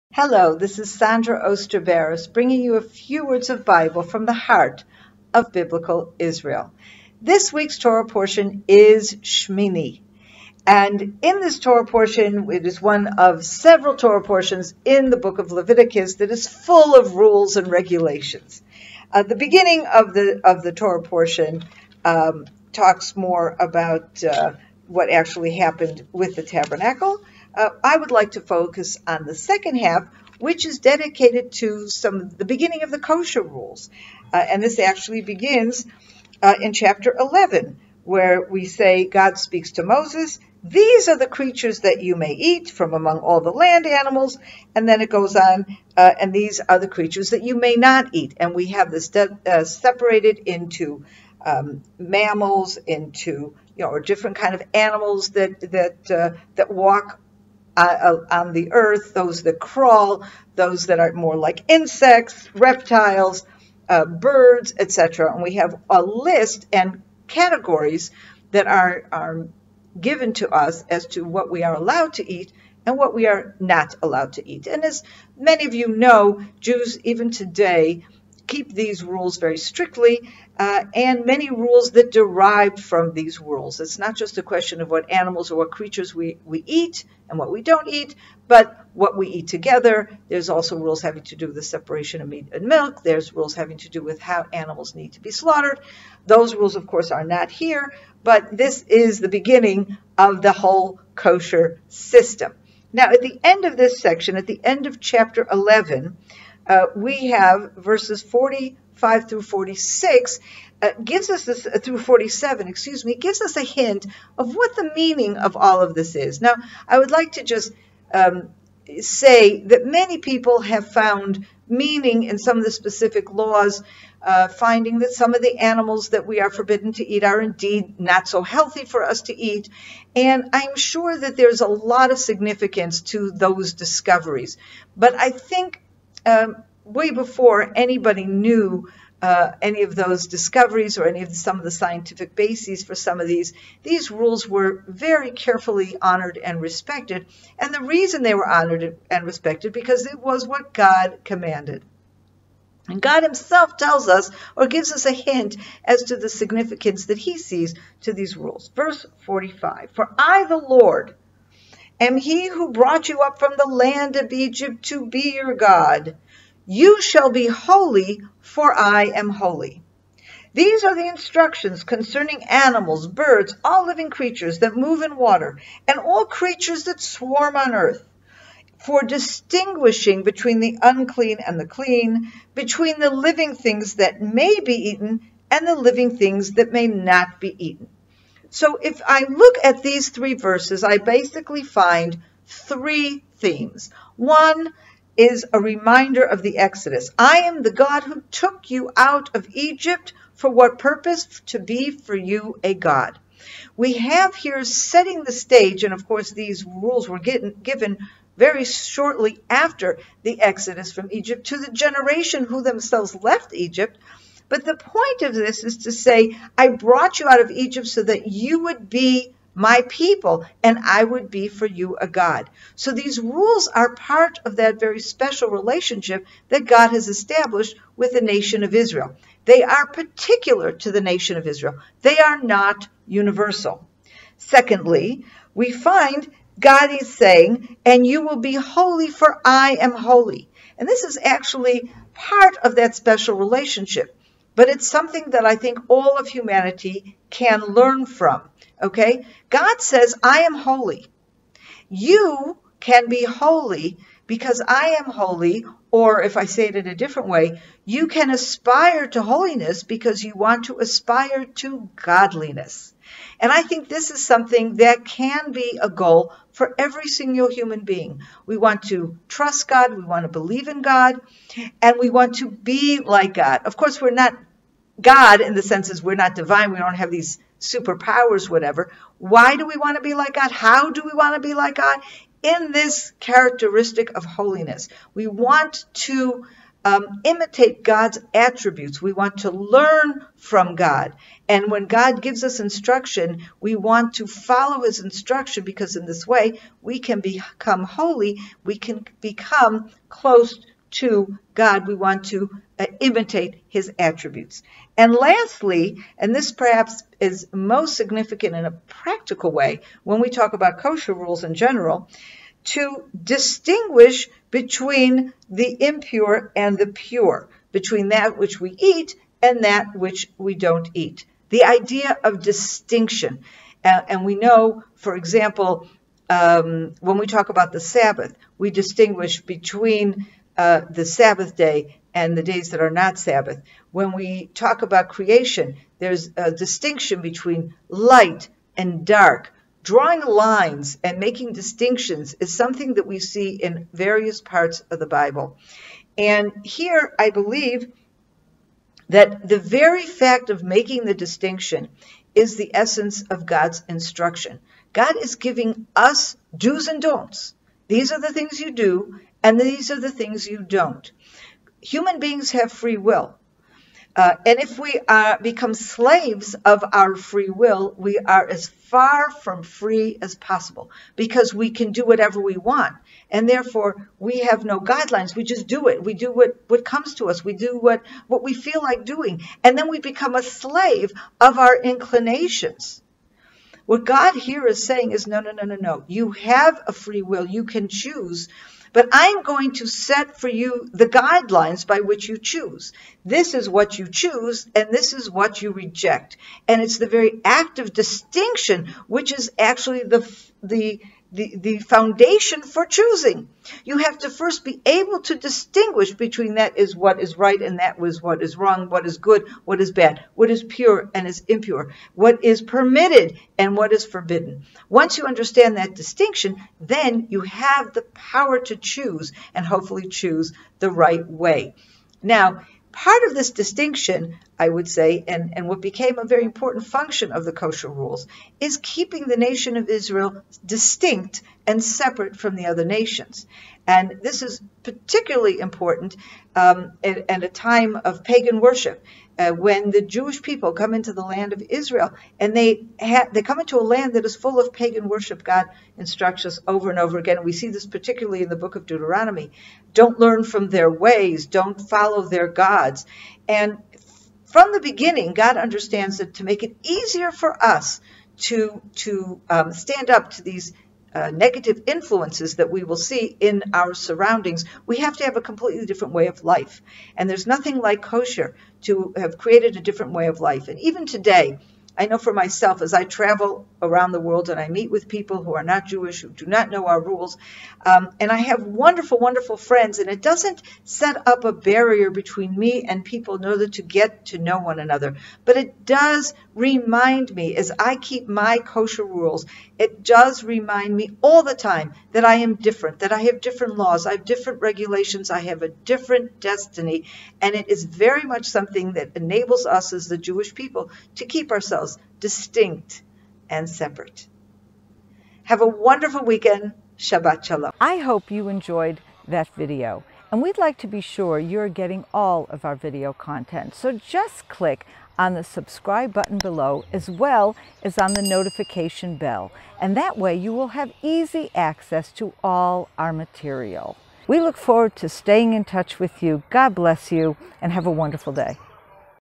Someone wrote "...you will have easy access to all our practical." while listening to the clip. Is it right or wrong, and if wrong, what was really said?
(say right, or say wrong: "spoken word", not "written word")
wrong: "material", not "practical".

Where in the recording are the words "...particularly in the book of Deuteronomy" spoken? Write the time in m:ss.
7:27.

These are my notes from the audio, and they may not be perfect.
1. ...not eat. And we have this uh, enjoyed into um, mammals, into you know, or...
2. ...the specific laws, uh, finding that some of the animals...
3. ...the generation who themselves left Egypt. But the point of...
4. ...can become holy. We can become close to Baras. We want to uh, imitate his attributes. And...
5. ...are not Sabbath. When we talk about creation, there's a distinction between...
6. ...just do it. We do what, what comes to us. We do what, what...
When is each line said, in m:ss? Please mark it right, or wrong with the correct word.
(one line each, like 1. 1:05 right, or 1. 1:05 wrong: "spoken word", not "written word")
1. 0:47 wrong: "separated", not "enjoyed"
2. 2:02 right
3. 3:31 right
4. 4:56 wrong: "God", not "Baras"
5. 5:32 right
6. 6:15 right.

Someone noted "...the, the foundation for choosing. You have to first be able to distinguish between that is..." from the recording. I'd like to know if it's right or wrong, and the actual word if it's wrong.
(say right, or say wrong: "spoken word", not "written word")
right.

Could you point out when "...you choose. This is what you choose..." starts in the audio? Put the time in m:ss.
6:32.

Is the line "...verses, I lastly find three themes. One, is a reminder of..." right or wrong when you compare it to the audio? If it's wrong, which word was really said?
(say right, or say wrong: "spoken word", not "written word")
wrong: "basically", not "lastly".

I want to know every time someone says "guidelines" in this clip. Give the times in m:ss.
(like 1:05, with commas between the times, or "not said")
6:14, 6:31.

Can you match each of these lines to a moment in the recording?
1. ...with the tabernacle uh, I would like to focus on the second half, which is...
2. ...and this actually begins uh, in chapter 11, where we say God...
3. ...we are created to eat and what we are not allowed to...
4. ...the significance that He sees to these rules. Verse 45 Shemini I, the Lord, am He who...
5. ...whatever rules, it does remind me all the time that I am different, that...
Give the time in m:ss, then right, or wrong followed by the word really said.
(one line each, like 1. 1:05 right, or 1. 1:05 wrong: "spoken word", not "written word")
1. 0:26 right
2. 0:34 right
3. 1:11 wrong: "allowed", not "created"
4. 2:36 wrong: "For", not "Shemini"
5. 8:08 wrong: "kosher", not "whatever".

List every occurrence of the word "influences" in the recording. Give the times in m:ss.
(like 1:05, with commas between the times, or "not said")
7:41.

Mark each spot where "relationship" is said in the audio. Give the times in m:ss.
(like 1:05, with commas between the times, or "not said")
3:45, 4:03.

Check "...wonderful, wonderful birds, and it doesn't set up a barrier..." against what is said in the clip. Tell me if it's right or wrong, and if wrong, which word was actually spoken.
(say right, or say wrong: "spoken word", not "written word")
wrong: "friends", not "birds".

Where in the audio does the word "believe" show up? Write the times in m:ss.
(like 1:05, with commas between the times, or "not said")
4:30, 5:47.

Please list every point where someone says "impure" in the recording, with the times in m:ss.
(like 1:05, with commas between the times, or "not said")
5:15, 6:51.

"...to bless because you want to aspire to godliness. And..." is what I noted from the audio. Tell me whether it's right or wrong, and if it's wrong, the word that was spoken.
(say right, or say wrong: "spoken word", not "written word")
wrong: "holiness", not "bless".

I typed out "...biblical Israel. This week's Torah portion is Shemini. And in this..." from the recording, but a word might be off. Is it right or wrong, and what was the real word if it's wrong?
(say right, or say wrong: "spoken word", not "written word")
right.